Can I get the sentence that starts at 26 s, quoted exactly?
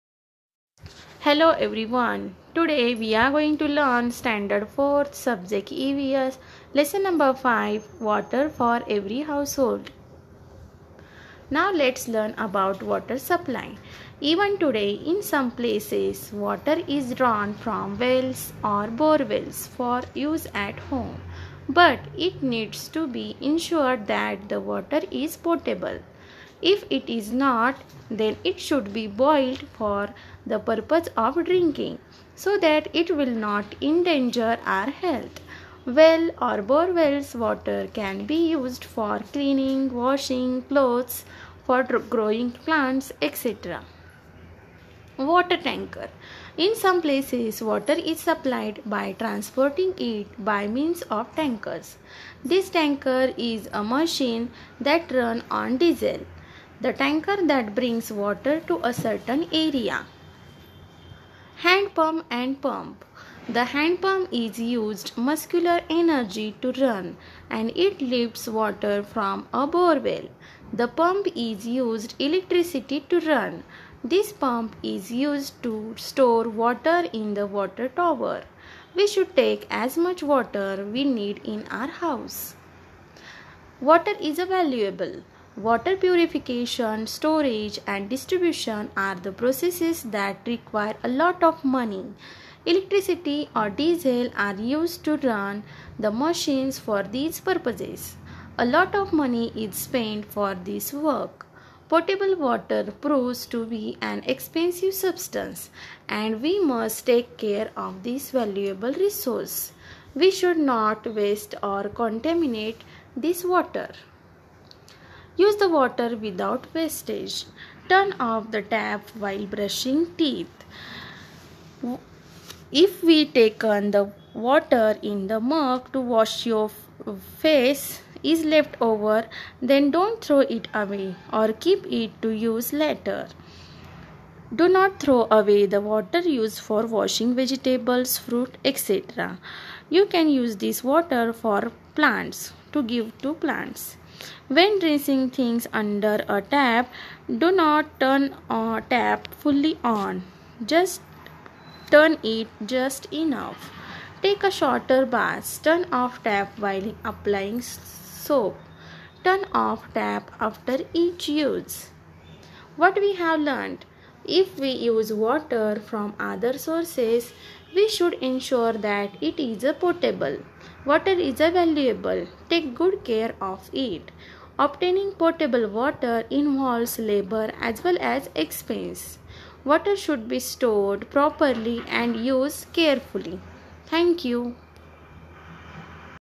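If it is not, then it should be boiled for the purpose of drinking so that it will not endanger our health.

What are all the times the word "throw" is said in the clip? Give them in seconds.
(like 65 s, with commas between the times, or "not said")
130 s, 134 s.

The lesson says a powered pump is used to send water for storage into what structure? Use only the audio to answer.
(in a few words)
Water tower.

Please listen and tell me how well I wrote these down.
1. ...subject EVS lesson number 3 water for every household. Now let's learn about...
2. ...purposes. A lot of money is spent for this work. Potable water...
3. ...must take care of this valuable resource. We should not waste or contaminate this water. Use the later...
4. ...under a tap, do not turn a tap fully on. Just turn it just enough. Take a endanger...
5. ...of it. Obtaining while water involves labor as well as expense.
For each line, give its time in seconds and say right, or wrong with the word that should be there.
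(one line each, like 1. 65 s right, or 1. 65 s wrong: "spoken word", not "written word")
1. 5 s wrong: "5", not "3"
2. 97 s right
3. 106 s wrong: "water", not "later"
4. 145 s wrong: "shorter", not "endanger"
5. 173 s wrong: "potable", not "while".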